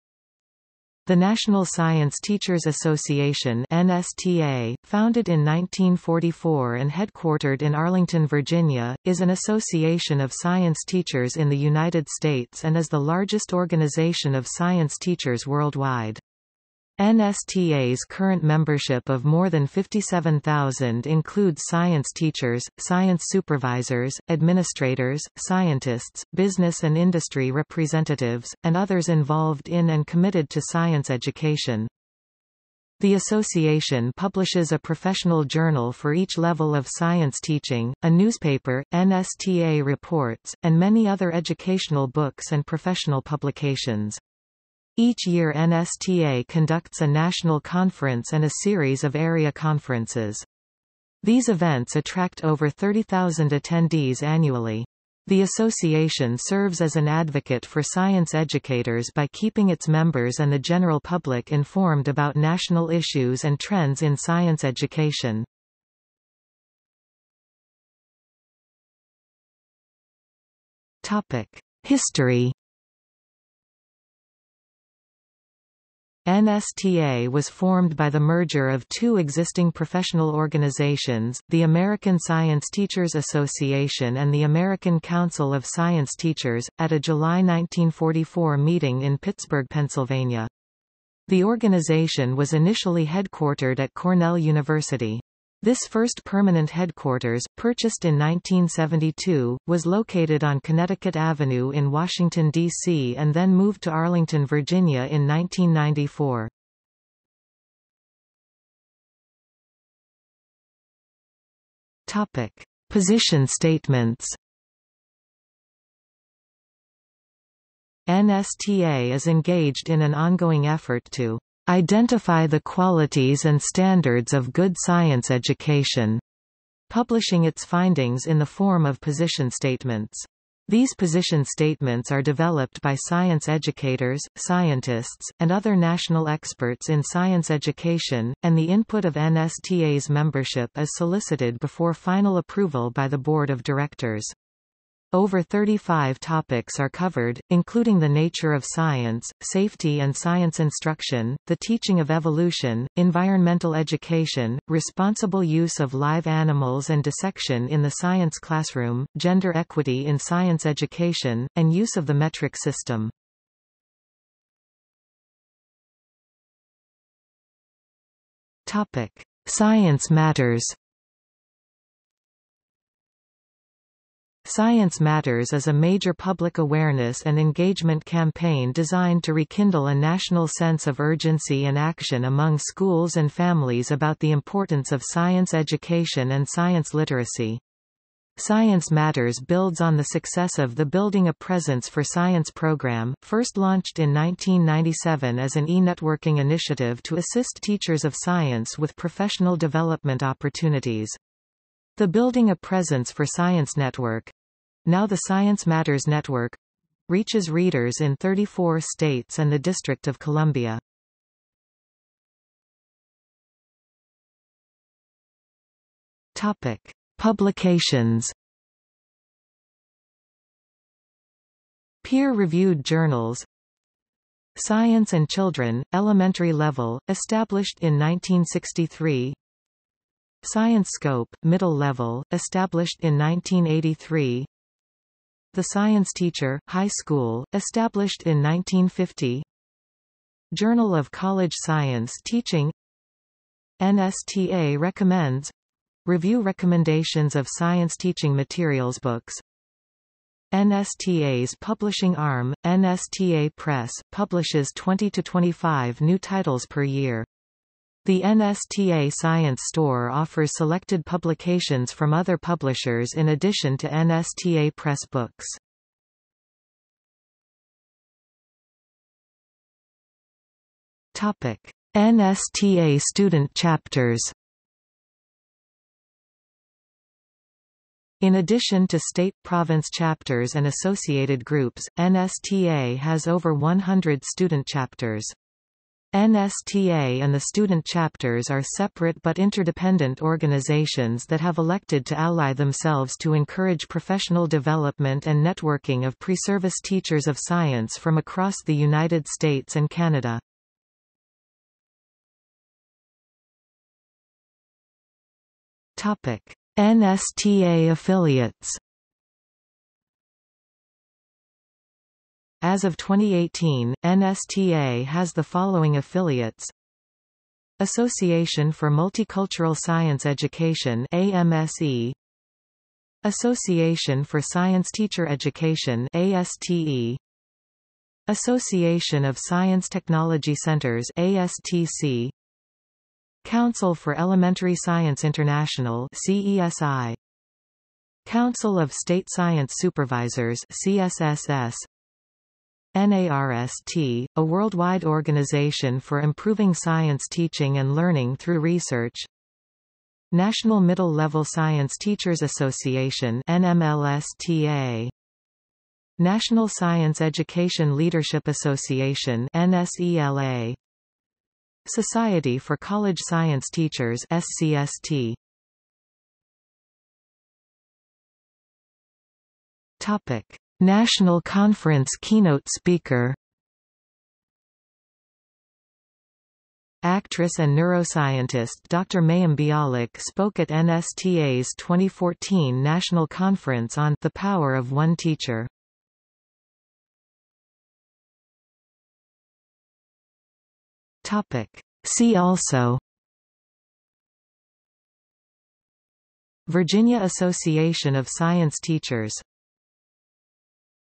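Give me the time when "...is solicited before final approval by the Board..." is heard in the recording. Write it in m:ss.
2:20.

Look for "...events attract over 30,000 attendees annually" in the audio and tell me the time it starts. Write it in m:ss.
0:51.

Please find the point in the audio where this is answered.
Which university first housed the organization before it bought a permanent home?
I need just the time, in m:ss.
1:33.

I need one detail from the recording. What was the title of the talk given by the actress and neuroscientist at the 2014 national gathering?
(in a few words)
The Power of One Teacher.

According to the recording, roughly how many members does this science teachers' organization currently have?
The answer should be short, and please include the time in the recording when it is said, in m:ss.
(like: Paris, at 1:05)
more than 57,000, at 0:19.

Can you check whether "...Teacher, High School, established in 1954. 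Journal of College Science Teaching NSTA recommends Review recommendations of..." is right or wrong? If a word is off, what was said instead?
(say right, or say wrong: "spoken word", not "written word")
wrong: "1950", not "1954".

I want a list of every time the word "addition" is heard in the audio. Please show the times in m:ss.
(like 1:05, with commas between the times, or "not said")
4:23, 4:38.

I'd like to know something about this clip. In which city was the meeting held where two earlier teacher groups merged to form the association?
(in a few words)
Pittsburgh, Pennsylvania.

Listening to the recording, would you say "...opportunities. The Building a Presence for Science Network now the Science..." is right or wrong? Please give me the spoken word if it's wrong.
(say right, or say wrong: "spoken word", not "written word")
right.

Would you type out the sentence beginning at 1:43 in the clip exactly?
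and then moved to Arlington, Virginia in 1994.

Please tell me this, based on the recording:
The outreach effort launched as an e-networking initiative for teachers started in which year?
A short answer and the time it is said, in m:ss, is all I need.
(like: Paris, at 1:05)
1997, at 3:14.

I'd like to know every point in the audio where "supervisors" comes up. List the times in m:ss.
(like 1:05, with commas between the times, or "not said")
0:23, 5:39.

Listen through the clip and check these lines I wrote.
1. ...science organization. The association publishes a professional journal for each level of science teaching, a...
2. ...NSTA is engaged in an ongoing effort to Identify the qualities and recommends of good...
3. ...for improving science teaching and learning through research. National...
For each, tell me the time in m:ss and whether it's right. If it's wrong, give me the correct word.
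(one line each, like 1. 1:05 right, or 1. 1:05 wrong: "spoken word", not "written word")
1. 0:30 wrong: "education", not "organization"
2. 1:58 wrong: "standards", not "recommends"
3. 5:46 right.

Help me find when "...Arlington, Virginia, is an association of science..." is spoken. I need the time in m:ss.
0:07.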